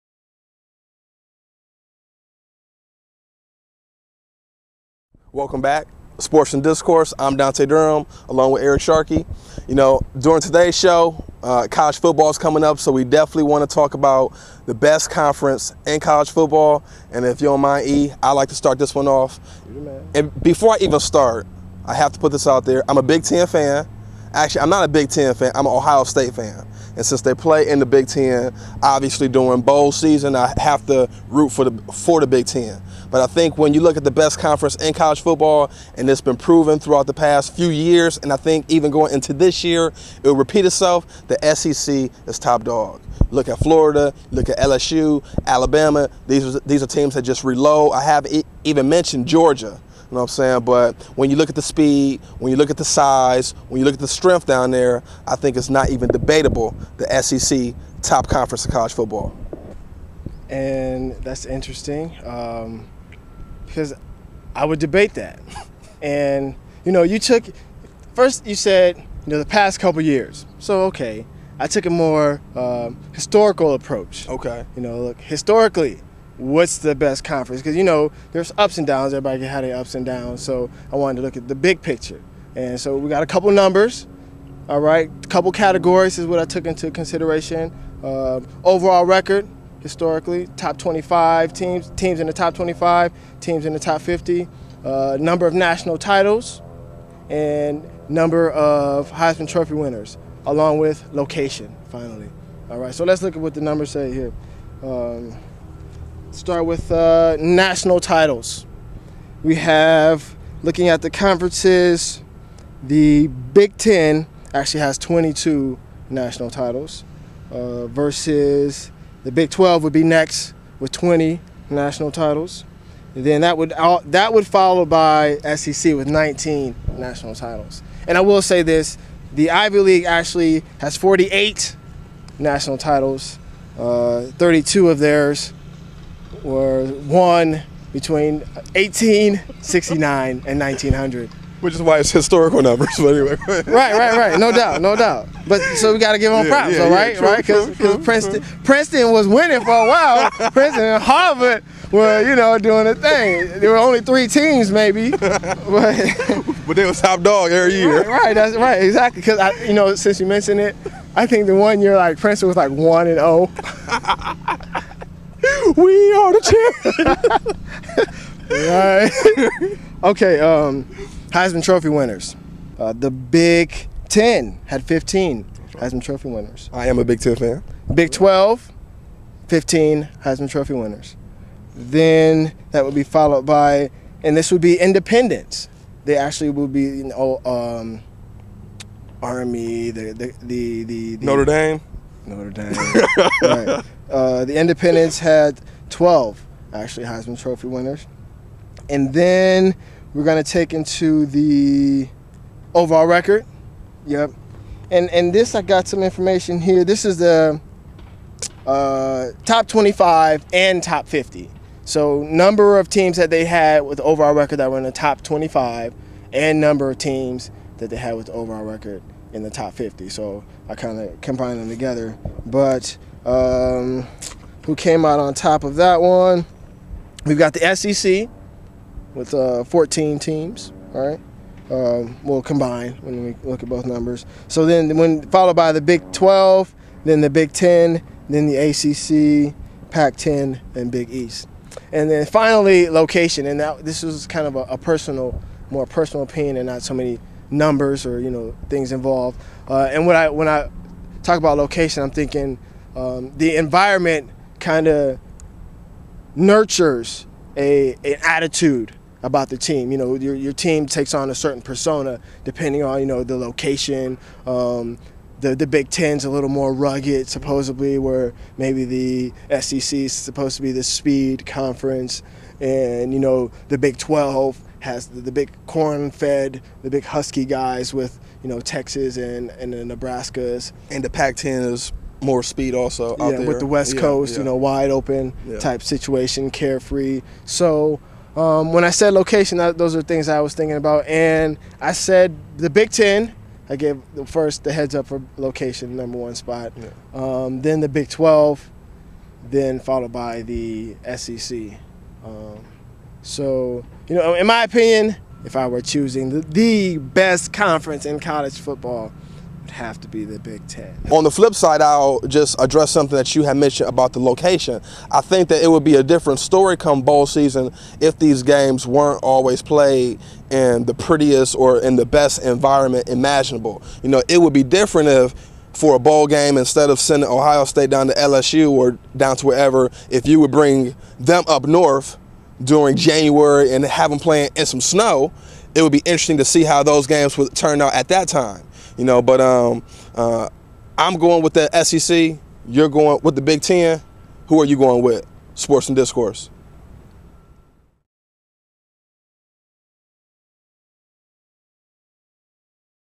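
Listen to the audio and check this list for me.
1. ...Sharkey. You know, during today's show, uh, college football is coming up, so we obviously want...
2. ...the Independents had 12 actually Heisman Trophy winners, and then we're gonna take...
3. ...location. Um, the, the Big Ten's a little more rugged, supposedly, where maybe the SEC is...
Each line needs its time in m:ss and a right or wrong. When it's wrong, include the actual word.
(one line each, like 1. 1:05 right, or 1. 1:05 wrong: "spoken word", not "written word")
1. 0:08 wrong: "definitely", not "obviously"
2. 3:14 right
3. 4:23 right.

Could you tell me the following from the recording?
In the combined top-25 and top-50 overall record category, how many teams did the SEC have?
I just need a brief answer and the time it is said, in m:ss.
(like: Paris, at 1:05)
14, at 3:49.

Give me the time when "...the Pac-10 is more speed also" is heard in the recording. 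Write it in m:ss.
4:41.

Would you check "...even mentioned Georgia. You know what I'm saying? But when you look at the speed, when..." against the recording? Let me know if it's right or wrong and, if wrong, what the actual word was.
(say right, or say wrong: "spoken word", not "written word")
right.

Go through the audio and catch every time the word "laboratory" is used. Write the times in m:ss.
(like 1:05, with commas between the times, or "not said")
not said.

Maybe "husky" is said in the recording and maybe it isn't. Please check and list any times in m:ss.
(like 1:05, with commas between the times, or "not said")
4:37.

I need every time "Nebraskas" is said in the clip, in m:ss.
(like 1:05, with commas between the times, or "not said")
4:39.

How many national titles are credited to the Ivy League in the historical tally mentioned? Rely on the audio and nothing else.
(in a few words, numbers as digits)
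48.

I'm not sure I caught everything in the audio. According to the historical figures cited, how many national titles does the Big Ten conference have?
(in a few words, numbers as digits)
22.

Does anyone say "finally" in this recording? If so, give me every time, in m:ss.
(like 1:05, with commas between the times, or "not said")
1:41, 4:02.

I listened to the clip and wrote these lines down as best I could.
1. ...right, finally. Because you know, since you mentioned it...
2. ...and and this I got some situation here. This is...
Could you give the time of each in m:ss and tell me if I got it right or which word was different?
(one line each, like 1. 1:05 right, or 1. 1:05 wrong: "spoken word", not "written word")
1. 2:38 wrong: "exactly", not "finally"
2. 3:24 wrong: "information", not "situation".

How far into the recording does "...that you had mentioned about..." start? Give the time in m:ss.
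5:13.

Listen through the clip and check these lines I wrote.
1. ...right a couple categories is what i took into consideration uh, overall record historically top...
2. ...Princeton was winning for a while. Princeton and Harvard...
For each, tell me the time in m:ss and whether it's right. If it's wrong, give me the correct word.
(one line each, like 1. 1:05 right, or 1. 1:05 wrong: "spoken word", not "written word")
1. 1:24 right
2. 2:28 right.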